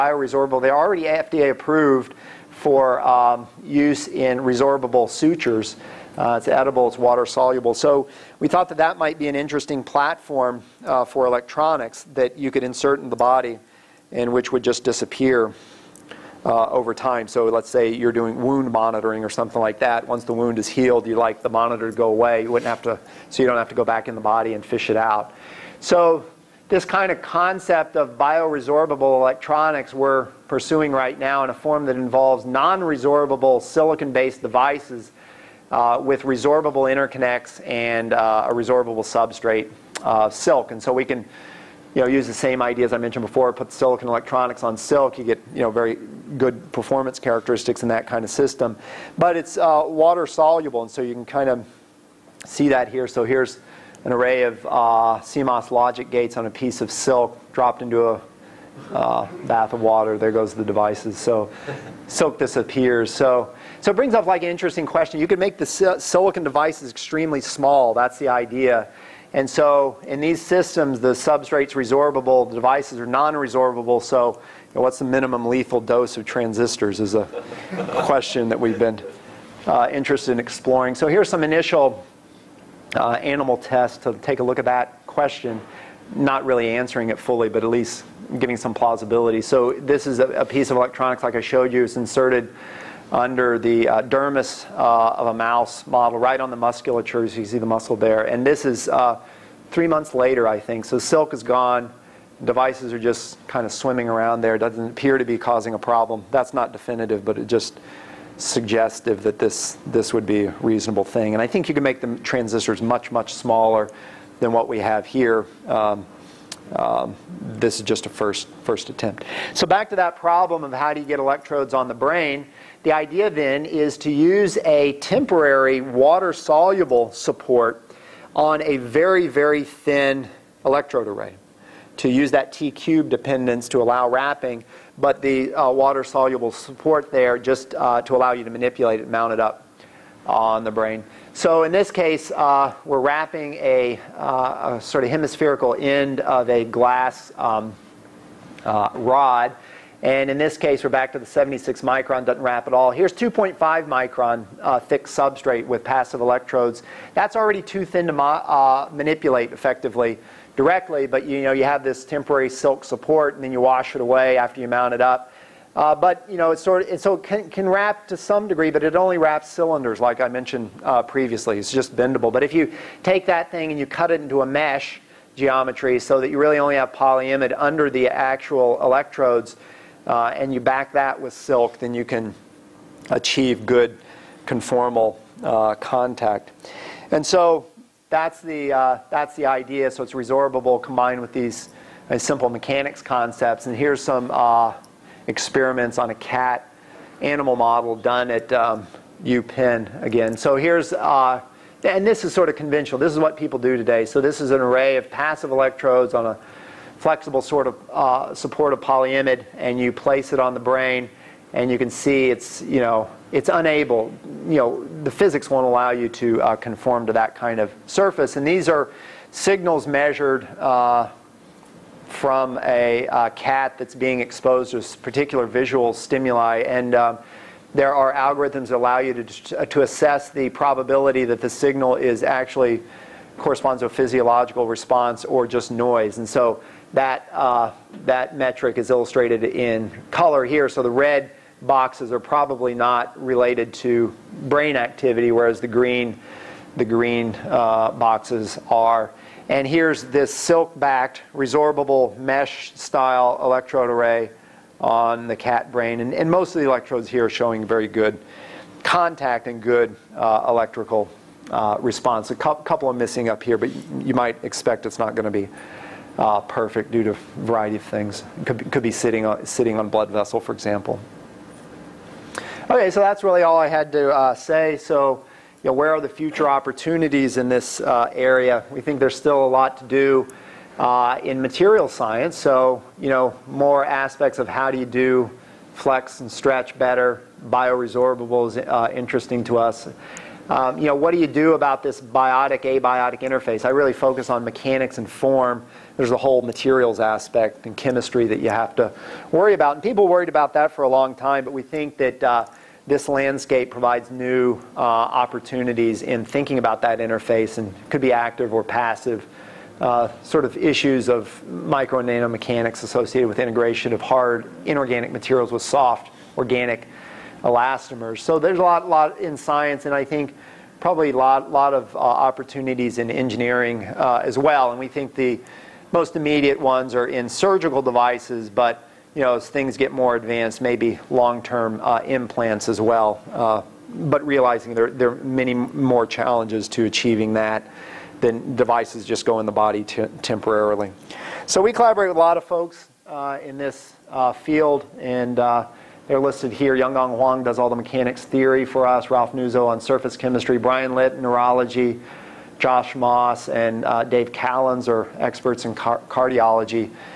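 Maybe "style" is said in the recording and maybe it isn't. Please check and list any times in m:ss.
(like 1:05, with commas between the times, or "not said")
4:12.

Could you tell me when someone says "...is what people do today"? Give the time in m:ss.
3:23.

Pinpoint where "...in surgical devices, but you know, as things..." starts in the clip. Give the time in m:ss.
5:27.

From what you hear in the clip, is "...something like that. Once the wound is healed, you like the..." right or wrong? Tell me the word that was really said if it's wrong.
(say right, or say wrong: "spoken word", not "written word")
right.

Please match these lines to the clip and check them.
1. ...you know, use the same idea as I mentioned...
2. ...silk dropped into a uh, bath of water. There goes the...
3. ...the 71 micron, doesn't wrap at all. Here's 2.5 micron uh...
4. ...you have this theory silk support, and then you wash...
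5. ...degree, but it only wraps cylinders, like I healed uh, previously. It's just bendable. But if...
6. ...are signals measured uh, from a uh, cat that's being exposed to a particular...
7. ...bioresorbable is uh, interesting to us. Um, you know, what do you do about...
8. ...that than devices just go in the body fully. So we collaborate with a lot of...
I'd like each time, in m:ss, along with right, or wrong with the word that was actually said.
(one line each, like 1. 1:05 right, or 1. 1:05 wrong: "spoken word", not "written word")
1. 0:41 right
2. 0:56 right
3. 2:31 wrong: "76", not "71"
4. 2:41 wrong: "temporary", not "theory"
5. 2:48 wrong: "mentioned", not "healed"
6. 3:38 right
7. 4:47 right
8. 5:37 wrong: "temporarily", not "fully".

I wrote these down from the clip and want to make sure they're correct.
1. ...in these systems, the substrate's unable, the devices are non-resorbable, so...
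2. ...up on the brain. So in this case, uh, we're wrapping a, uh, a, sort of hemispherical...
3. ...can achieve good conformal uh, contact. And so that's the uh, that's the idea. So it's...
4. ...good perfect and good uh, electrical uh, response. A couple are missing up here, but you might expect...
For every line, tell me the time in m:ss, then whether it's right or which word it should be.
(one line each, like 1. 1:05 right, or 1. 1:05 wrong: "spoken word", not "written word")
1. 1:10 wrong: "resorbable", not "unable"
2. 2:19 right
3. 3:02 right
4. 4:17 wrong: "contact", not "perfect".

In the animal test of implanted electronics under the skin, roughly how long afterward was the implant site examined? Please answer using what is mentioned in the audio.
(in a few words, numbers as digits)
3 months.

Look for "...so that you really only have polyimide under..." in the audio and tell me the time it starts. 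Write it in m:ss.
2:56.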